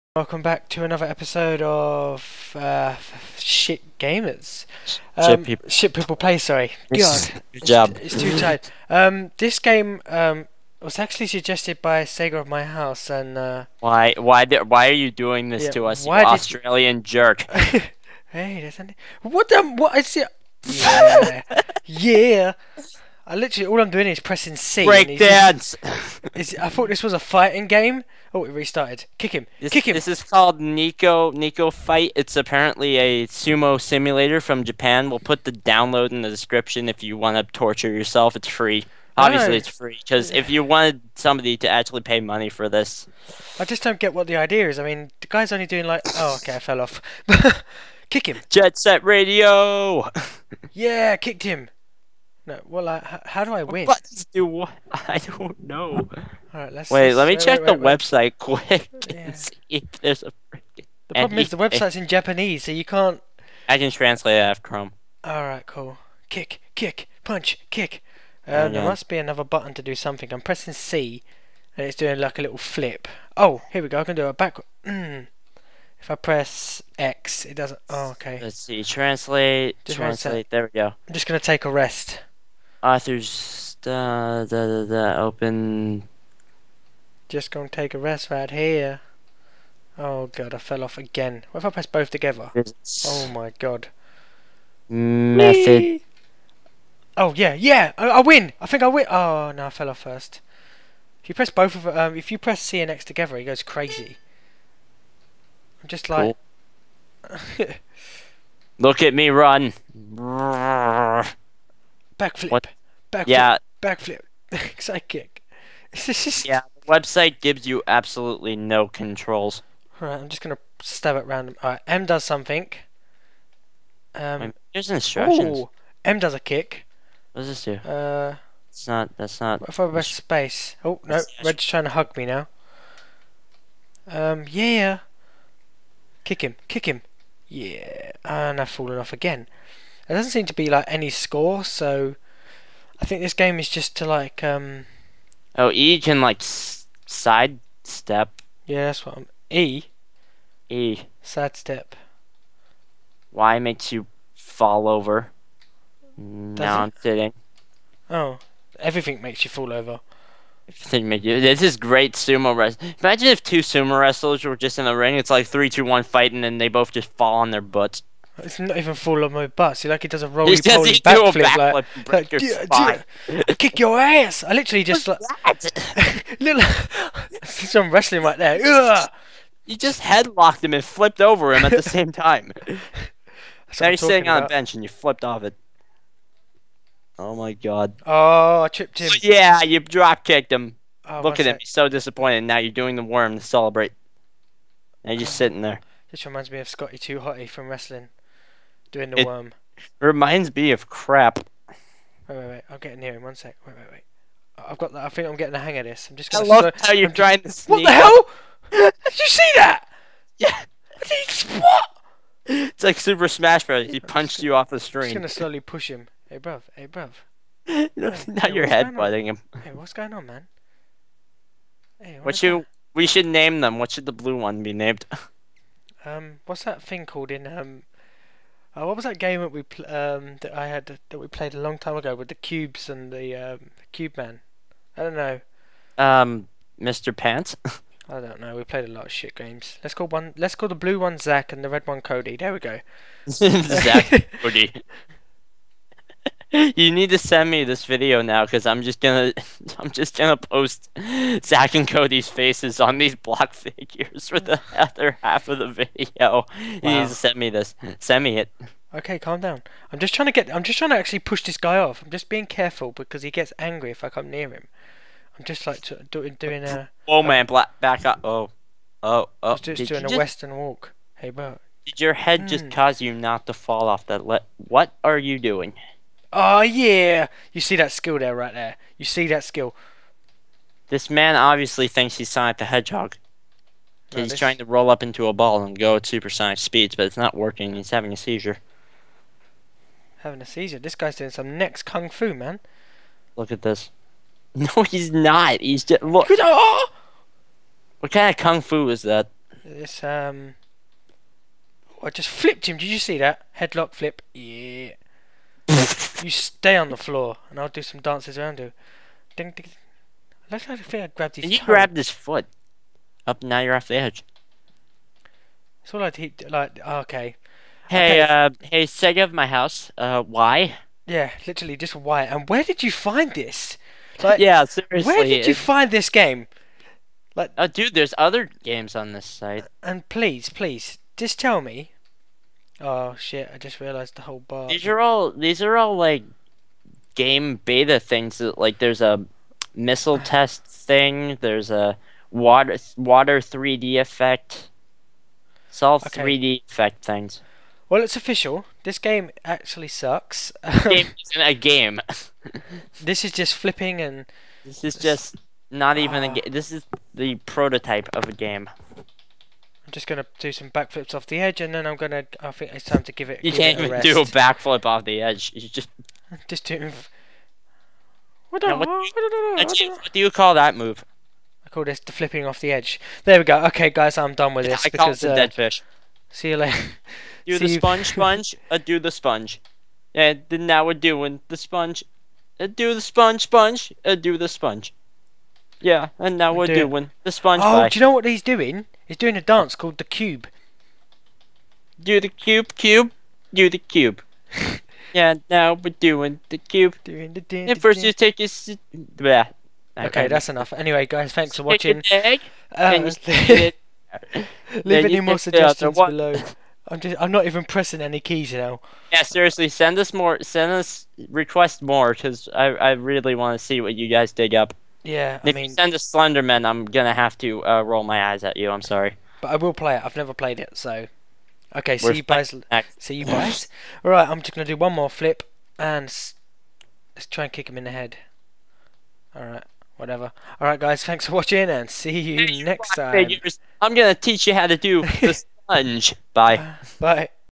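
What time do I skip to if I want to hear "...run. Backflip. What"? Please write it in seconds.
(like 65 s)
109 s.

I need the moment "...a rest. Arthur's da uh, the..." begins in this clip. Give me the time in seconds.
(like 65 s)
81 s.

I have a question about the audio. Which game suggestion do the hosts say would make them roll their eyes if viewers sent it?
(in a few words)
Slenderman.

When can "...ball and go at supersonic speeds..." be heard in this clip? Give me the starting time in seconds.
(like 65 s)
285 s.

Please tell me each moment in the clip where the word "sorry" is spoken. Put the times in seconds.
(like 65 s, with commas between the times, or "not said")
6 s, 418 s.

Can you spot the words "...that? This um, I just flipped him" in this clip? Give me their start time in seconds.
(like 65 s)
299 s.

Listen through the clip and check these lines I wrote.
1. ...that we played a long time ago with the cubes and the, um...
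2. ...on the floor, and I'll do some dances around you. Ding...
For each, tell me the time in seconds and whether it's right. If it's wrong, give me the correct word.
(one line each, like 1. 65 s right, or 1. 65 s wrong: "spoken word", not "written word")
1. 231 s right
2. 306 s right.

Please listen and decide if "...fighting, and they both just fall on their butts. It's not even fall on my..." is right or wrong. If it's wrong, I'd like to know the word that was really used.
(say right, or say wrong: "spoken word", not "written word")
right.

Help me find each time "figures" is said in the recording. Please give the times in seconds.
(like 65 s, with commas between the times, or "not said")
253 s, 433 s.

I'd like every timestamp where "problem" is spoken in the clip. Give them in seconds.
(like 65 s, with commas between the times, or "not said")
61 s.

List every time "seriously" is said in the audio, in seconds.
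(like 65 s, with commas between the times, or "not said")
324 s, 409 s.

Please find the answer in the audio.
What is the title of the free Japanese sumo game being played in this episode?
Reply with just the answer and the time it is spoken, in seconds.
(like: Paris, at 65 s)
Neko Neko Fight, at 30 s.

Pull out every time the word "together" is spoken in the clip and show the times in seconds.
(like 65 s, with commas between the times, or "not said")
92 s, 103 s.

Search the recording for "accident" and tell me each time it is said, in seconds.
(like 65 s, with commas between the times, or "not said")
not said.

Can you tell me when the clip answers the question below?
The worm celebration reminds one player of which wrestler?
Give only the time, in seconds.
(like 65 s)
196 s.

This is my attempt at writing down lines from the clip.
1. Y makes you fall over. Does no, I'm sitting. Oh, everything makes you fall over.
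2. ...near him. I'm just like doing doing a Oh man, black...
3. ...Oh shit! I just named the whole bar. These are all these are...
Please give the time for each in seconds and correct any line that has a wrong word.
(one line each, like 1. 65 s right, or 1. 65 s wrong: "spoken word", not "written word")
1. 153 s right
2. 264 s right
3. 332 s wrong: "realized", not "named".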